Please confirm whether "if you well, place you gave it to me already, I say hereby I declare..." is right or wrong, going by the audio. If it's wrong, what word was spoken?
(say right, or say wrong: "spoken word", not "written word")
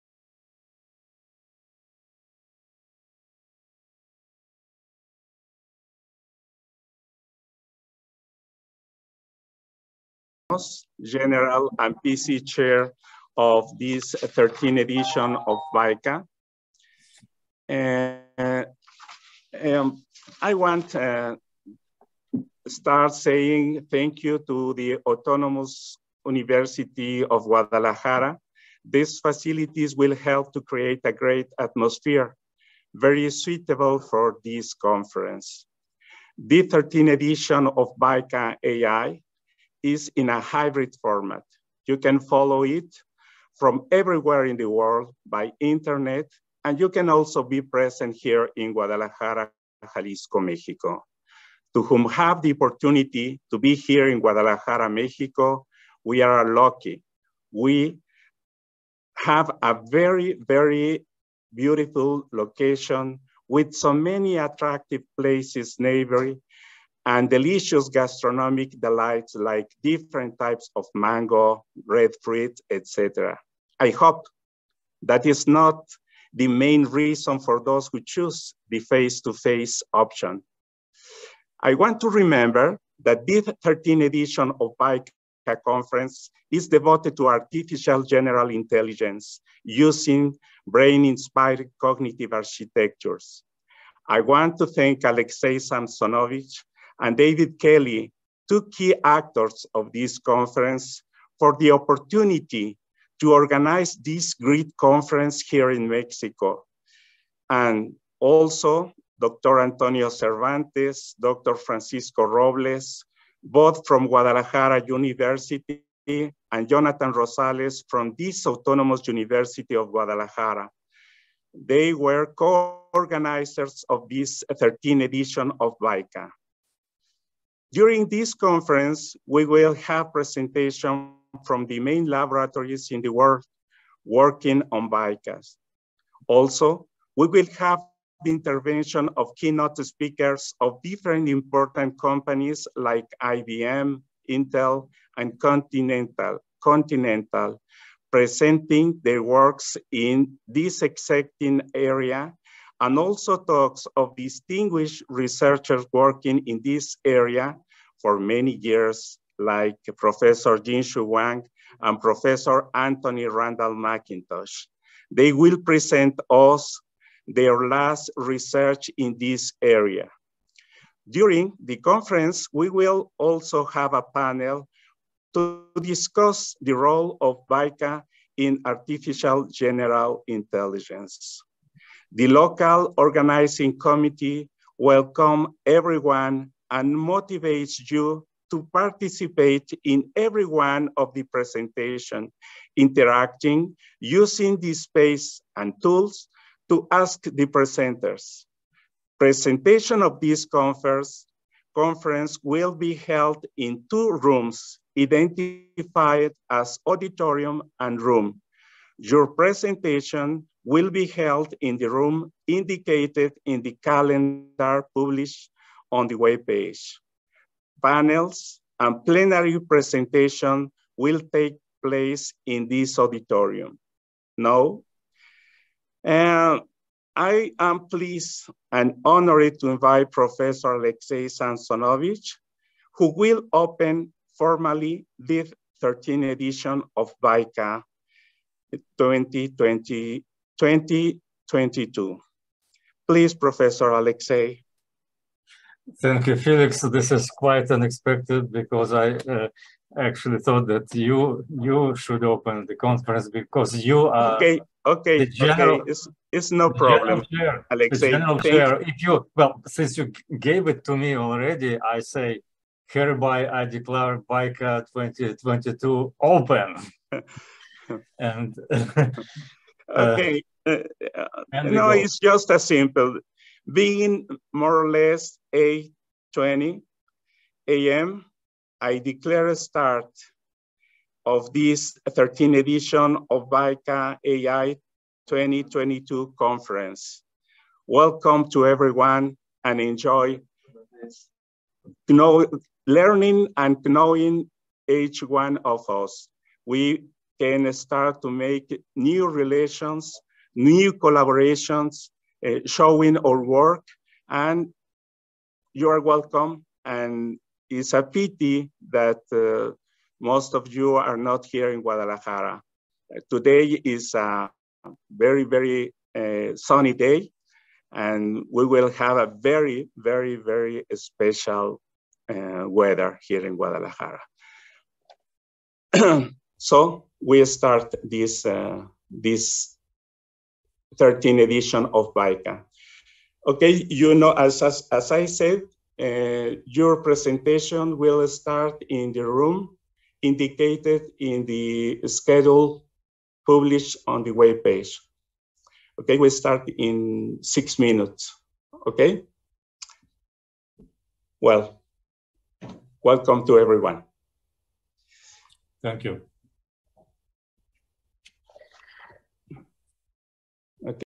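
wrong: "since", not "place".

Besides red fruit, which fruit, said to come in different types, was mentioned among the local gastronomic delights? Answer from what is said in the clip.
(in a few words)
mango.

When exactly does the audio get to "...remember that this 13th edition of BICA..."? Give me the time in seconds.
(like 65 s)
82 s.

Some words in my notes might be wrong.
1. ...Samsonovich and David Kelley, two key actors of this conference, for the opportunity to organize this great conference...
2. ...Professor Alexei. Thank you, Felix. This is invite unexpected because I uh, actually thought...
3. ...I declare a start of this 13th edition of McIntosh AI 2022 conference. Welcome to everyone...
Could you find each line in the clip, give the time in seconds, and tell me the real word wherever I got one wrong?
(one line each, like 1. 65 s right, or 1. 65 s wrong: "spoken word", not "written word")
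1. 95 s right
2. 243 s wrong: "quite", not "invite"
3. 278 s wrong: "BICA", not "McIntosh".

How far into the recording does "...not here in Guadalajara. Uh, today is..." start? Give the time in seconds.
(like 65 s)
311 s.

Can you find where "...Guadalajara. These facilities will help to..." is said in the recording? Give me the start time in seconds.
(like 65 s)
27 s.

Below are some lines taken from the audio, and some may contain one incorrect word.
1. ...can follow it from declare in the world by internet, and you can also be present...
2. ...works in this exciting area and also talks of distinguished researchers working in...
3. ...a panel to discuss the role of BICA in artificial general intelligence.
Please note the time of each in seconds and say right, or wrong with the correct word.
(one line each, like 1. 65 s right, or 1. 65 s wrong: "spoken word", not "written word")
1. 41 s wrong: "everywhere", not "declare"
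2. 149 s right
3. 173 s right.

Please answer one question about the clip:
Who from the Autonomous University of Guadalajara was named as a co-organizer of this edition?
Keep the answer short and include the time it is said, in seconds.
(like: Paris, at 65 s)
Jonathan Rosales, at 116 s.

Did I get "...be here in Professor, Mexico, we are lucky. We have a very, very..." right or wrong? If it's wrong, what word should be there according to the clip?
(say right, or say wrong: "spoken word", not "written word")
wrong: "Guadalajara", not "Professor".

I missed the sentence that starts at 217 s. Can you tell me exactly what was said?
Panels and plenary presentation will take place in this auditorium.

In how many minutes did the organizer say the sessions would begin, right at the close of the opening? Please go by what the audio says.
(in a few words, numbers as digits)
6.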